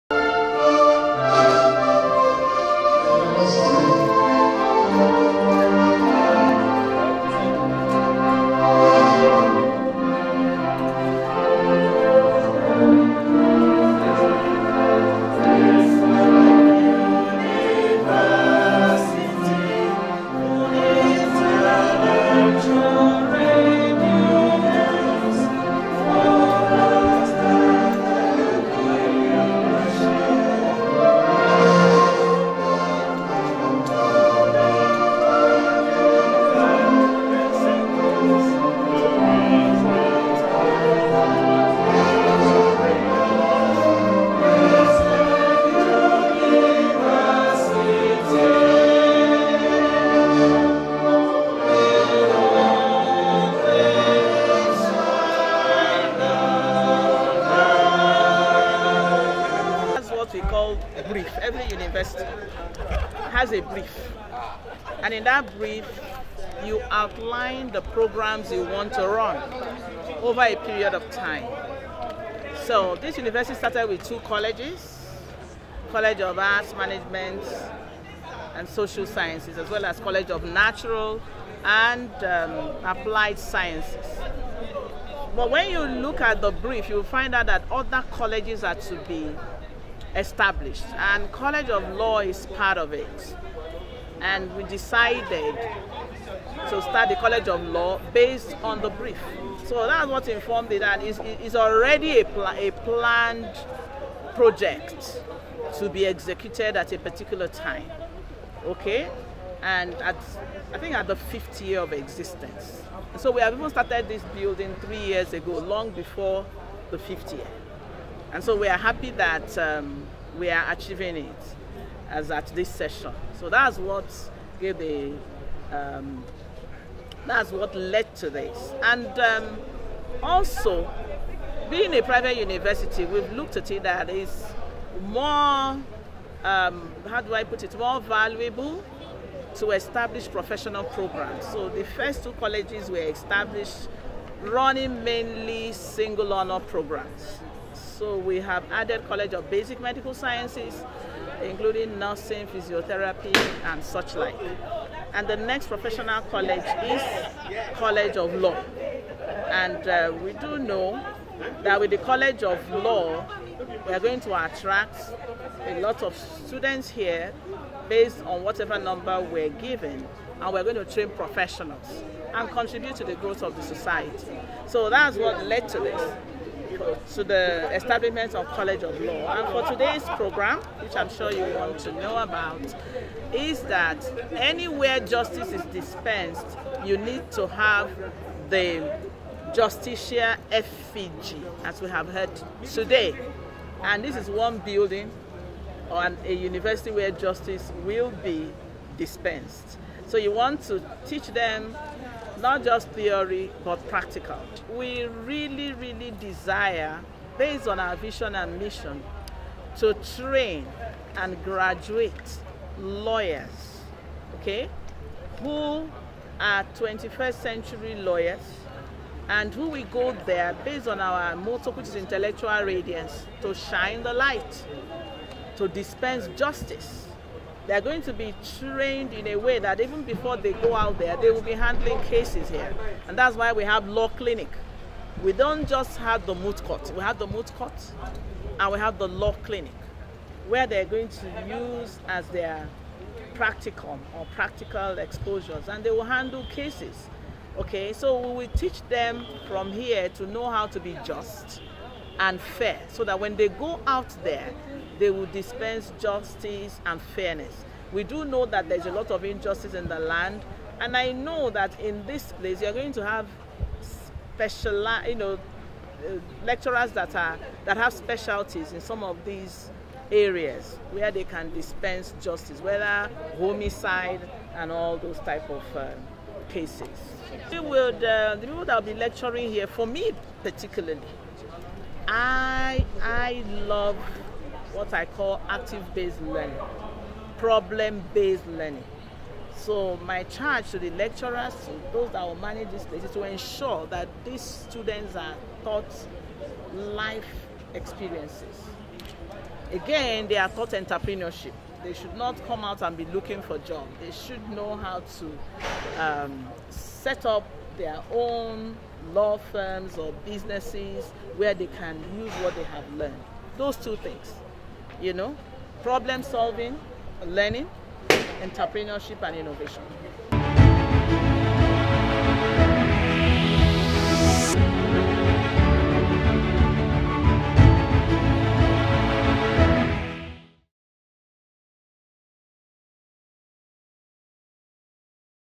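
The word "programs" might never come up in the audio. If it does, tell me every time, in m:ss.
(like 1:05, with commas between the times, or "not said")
1:07, 2:20, 2:26, 3:00.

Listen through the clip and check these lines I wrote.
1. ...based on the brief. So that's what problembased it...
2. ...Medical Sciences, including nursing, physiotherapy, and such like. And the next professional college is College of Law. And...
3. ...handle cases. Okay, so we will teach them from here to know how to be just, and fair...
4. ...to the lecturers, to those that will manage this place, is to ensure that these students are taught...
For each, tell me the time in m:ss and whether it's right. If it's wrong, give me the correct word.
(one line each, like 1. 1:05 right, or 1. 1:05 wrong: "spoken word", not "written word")
1. 1:38 wrong: "informed", not "problembased"
2. 2:29 right
3. 4:06 right
4. 4:50 right.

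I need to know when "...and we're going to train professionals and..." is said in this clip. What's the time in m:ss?
2:50.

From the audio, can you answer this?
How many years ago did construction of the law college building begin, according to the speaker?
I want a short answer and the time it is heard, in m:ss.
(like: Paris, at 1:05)
3, at 1:54.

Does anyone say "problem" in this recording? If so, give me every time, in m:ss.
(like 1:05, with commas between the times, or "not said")
4:47, 5:15.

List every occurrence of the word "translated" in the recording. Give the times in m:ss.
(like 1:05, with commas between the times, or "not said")
not said.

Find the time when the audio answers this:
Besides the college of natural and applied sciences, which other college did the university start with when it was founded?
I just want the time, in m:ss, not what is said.
1:15.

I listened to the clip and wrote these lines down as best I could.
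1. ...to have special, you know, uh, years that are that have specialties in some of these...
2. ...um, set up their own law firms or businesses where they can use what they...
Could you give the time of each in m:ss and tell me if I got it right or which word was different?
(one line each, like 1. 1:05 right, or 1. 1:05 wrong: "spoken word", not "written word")
1. 4:22 wrong: "lecturers", not "years"
2. 5:06 right.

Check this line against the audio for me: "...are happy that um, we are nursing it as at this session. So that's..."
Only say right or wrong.
wrong.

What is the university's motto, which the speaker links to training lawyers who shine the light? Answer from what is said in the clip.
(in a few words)
Intellectual radiance.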